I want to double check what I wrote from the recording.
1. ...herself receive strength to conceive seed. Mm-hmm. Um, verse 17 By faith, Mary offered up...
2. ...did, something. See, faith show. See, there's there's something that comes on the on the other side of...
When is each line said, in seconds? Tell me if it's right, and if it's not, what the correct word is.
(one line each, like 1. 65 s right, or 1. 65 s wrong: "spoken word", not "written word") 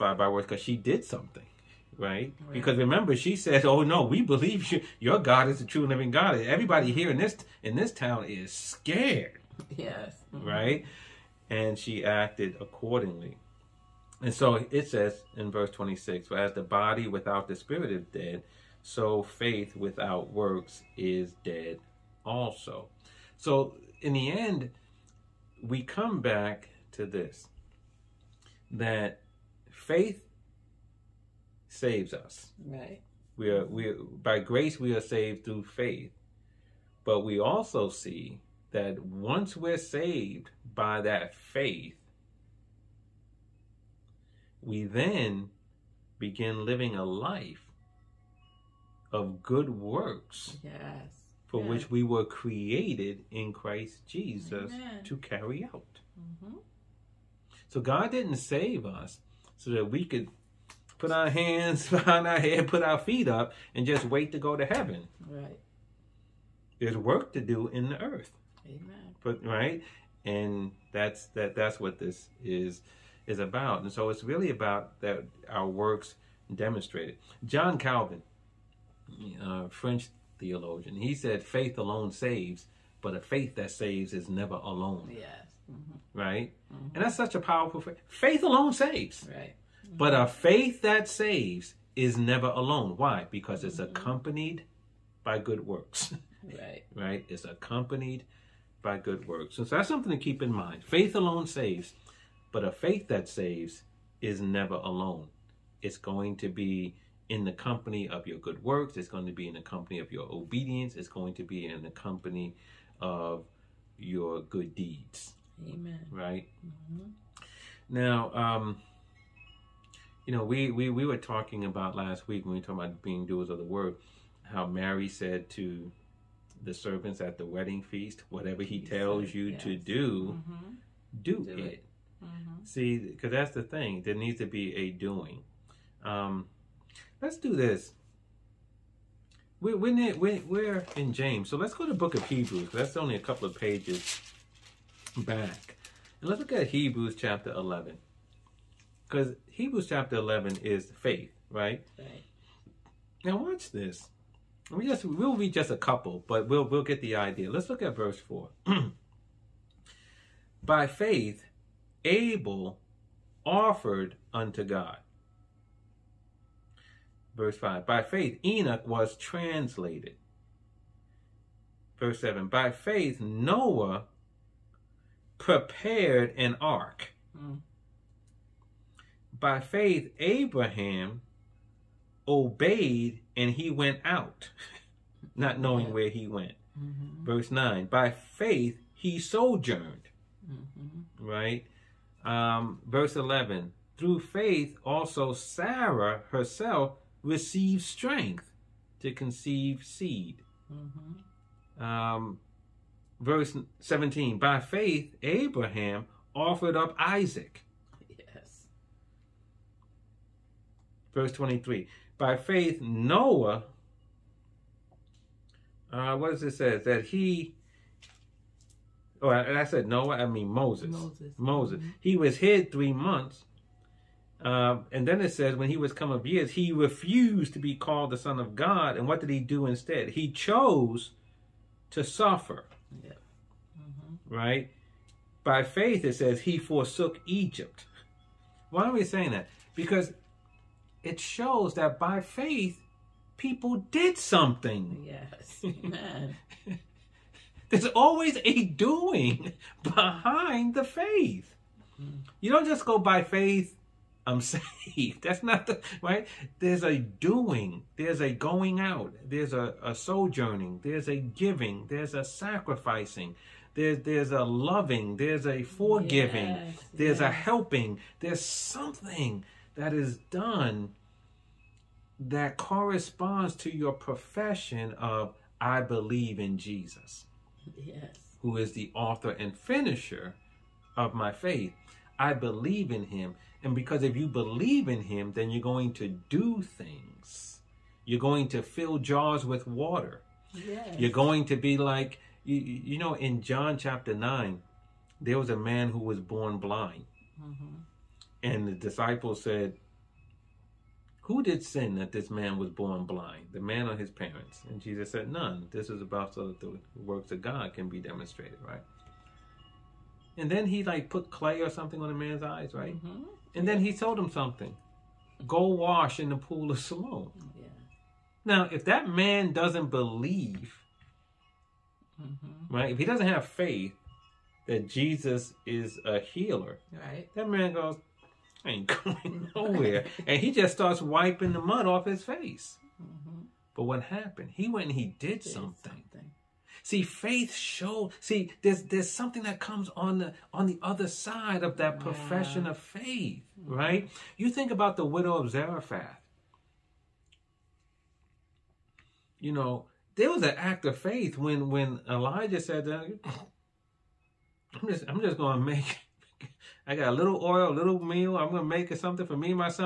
1. 196 s wrong: "Abraham", not "Mary"
2. 335 s right.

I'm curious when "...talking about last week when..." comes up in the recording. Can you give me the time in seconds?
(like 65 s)
121 s.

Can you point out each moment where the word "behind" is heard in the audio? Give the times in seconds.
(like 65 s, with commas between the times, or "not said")
61 s, 249 s.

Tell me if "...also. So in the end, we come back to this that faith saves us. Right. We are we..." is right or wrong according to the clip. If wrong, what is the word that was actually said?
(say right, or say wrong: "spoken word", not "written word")
right.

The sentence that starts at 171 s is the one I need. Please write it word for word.
Verse 7 By faith, Noah prepared an ark.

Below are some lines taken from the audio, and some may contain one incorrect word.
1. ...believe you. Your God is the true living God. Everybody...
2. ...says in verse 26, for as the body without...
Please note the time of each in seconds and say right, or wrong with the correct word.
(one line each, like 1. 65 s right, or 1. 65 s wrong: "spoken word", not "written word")
1. 4 s right
2. 14 s right.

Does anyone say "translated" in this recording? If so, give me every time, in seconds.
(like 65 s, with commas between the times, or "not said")
169 s.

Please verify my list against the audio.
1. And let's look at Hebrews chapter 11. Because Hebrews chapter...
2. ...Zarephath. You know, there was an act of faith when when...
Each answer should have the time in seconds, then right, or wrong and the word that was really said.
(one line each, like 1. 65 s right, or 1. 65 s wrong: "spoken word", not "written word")
1. 146 s right
2. 345 s right.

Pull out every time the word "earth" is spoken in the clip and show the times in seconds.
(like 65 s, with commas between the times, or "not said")
68 s.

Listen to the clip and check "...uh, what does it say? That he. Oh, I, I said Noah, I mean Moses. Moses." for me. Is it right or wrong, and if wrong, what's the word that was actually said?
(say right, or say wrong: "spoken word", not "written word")
right.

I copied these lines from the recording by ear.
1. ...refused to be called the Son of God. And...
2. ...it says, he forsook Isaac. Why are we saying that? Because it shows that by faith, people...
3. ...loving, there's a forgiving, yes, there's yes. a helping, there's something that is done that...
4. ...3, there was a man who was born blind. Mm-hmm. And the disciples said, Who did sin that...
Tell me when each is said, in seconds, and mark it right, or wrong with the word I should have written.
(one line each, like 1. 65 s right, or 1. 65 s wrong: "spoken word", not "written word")
1. 226 s right
2. 236 s wrong: "Egypt", not "Isaac"
3. 264 s right
4. 294 s wrong: "9", not "3".